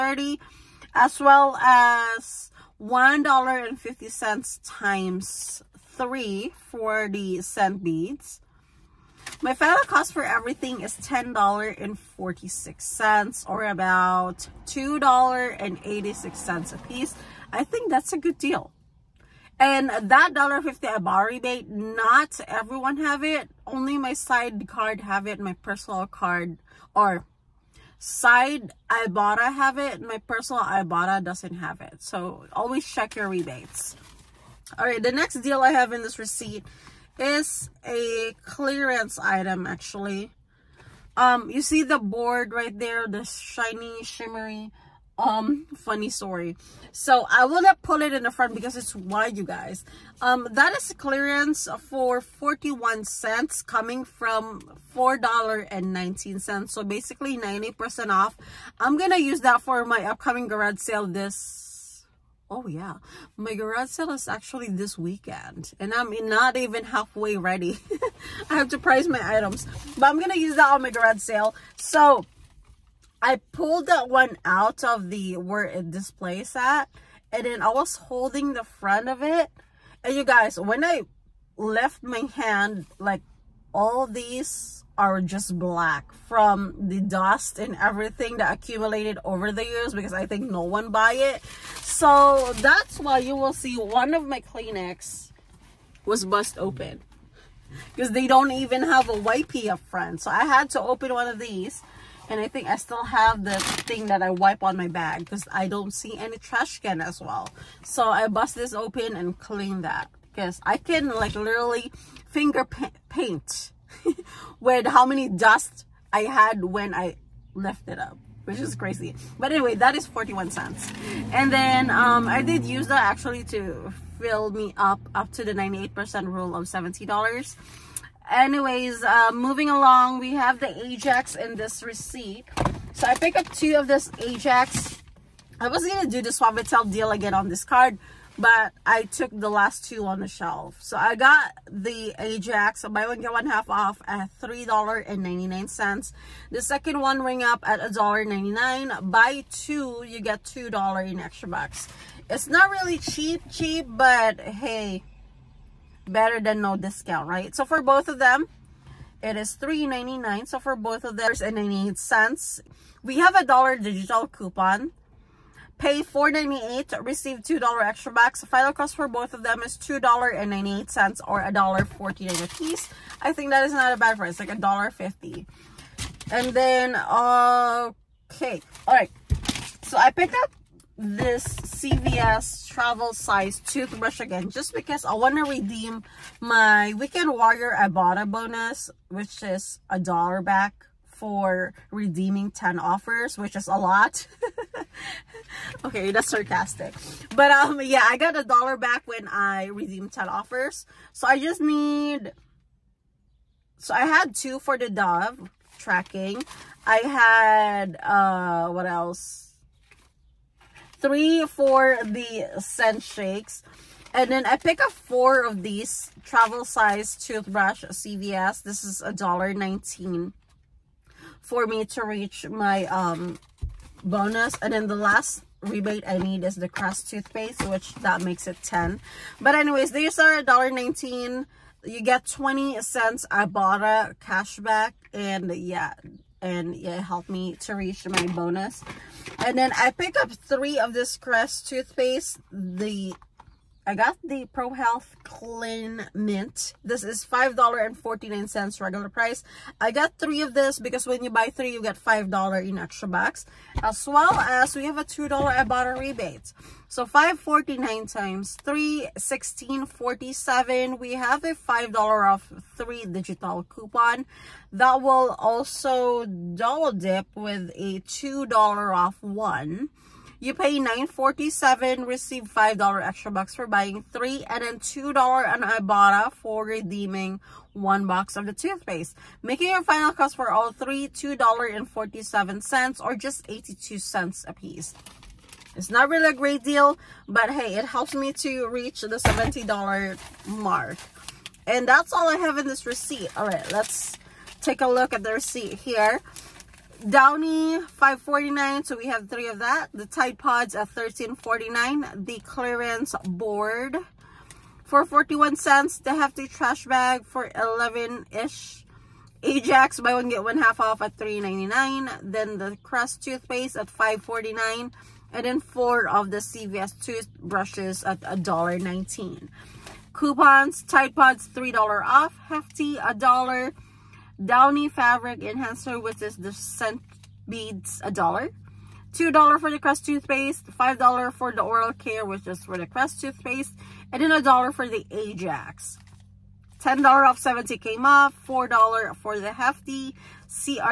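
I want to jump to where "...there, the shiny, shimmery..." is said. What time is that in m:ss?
0:42.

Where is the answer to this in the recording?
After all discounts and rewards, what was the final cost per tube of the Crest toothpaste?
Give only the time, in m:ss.
4:43.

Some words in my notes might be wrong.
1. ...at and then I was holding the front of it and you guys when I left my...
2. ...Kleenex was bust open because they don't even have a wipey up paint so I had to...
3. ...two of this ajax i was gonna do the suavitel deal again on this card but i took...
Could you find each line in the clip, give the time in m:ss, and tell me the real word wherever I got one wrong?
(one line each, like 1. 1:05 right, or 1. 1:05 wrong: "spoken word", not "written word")
1. 1:16 right
2. 1:34 wrong: "front", not "paint"
3. 2:13 right.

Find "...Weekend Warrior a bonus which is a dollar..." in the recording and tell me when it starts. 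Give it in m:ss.
3:06.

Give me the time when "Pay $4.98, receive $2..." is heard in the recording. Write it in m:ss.
2:45.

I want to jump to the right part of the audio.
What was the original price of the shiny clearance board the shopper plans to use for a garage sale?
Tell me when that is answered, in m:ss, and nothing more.
0:54.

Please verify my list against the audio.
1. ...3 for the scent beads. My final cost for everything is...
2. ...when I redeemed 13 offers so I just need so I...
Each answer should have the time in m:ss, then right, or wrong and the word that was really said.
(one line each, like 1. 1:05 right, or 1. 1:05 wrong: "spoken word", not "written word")
1. 0:05 right
2. 3:19 wrong: "10", not "13".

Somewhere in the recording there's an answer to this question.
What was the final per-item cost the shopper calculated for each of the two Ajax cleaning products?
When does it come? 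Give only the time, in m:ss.
2:51.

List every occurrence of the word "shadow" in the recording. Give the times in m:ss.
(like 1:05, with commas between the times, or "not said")
not said.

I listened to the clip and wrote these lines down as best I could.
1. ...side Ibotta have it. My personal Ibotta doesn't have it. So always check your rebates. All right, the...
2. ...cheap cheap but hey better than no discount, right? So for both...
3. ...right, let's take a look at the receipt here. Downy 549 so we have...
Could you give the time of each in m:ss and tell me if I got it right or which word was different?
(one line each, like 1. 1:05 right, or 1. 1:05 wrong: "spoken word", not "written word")
1. 0:27 right
2. 2:32 right
3. 4:53 right.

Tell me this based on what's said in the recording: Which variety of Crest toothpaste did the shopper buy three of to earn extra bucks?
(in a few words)
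Pro Health Clean Mint.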